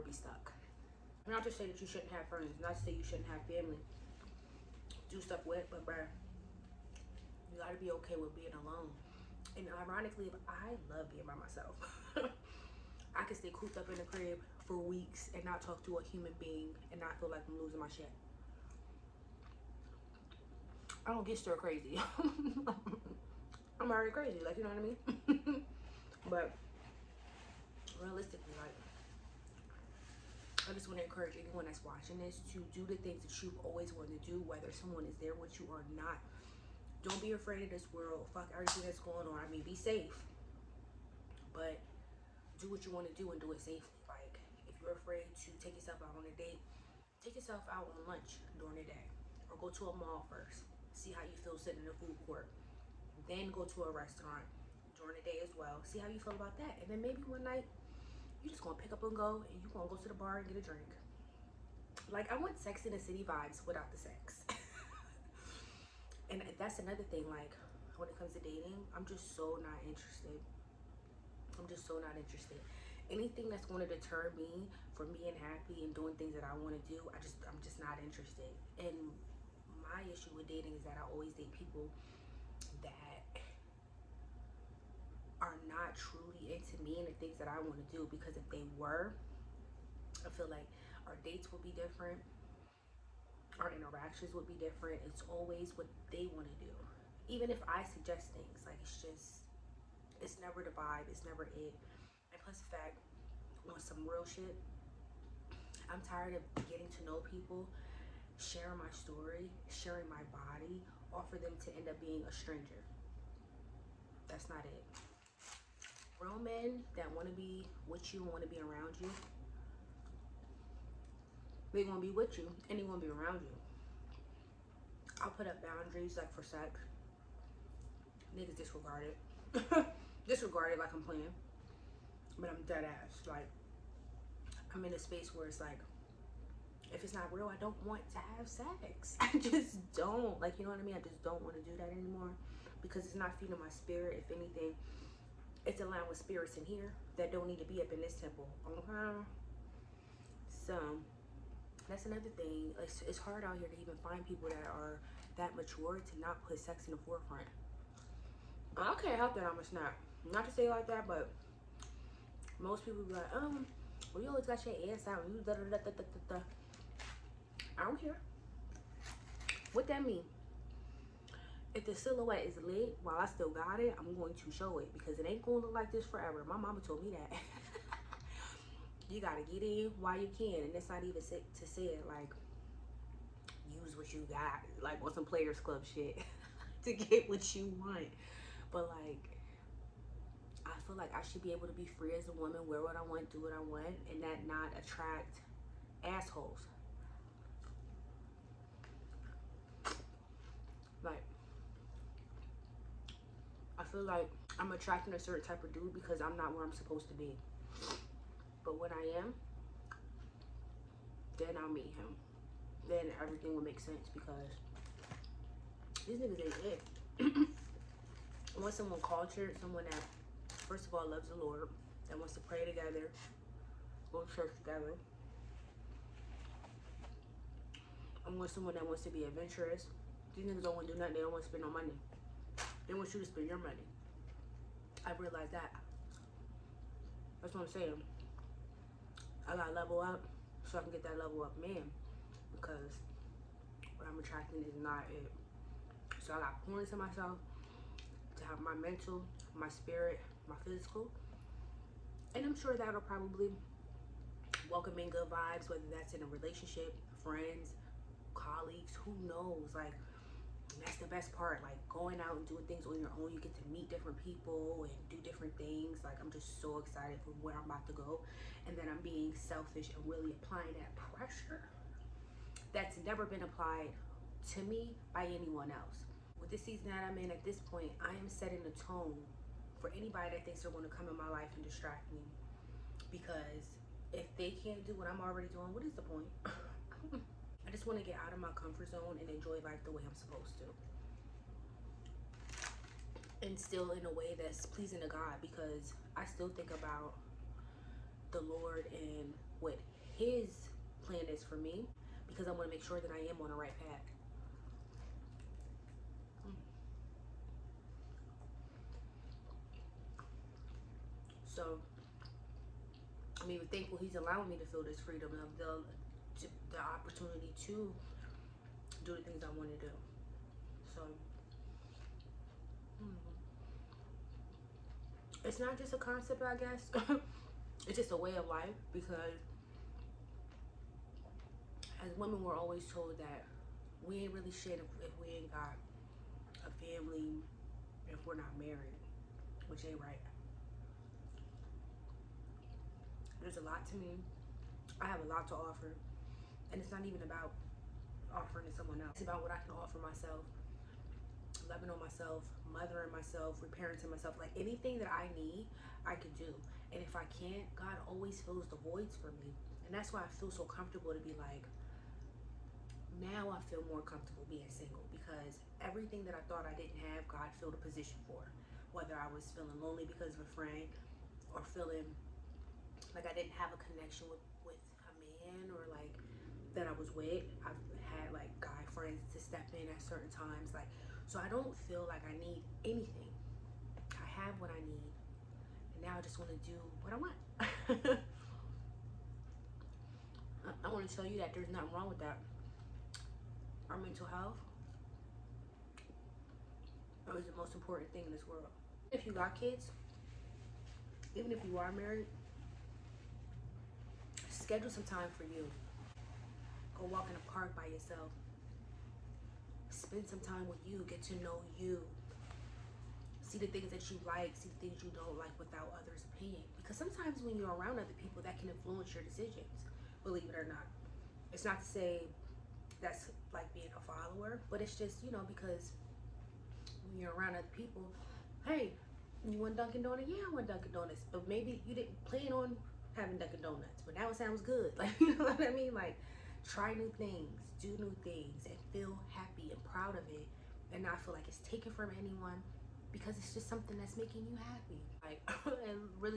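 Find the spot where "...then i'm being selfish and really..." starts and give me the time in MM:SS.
04:28.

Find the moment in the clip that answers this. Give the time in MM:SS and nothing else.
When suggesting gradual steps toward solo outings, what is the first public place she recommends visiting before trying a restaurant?
00:49.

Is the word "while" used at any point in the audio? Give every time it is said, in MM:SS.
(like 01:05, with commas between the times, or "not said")
02:53, 02:59.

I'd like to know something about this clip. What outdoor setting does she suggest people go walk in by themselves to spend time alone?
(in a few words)
A park.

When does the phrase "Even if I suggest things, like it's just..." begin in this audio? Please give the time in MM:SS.
01:37.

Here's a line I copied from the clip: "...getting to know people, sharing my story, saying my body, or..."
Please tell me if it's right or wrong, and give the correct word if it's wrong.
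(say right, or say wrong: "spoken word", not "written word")
wrong: "sharing", not "saying".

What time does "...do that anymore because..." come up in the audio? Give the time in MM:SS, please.
02:21.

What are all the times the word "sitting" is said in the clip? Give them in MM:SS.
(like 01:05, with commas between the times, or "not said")
00:51.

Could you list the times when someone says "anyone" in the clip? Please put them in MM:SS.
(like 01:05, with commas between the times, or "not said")
00:31, 04:35, 07:22.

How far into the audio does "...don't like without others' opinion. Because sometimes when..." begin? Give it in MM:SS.
06:55.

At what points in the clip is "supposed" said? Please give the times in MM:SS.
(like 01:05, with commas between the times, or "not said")
03:26, 04:50.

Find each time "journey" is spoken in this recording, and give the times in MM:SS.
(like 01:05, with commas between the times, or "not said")
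not said.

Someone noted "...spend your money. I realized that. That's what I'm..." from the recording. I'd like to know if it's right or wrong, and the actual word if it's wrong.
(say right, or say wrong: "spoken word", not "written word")
right.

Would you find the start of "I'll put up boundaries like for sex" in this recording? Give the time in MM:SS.
02:05.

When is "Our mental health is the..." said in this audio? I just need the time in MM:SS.
06:33.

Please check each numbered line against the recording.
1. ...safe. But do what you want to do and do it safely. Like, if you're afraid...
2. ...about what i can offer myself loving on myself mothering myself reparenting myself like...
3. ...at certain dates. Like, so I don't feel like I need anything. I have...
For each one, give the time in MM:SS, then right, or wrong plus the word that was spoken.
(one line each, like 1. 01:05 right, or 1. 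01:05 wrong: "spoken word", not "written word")
1. 00:39 right
2. 05:49 right
3. 06:19 wrong: "times", not "dates".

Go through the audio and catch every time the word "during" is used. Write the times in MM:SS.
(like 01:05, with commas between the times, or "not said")
00:48, 00:55.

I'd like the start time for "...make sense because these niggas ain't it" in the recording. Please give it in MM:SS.
03:33.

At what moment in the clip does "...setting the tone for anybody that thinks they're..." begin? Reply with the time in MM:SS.
04:38.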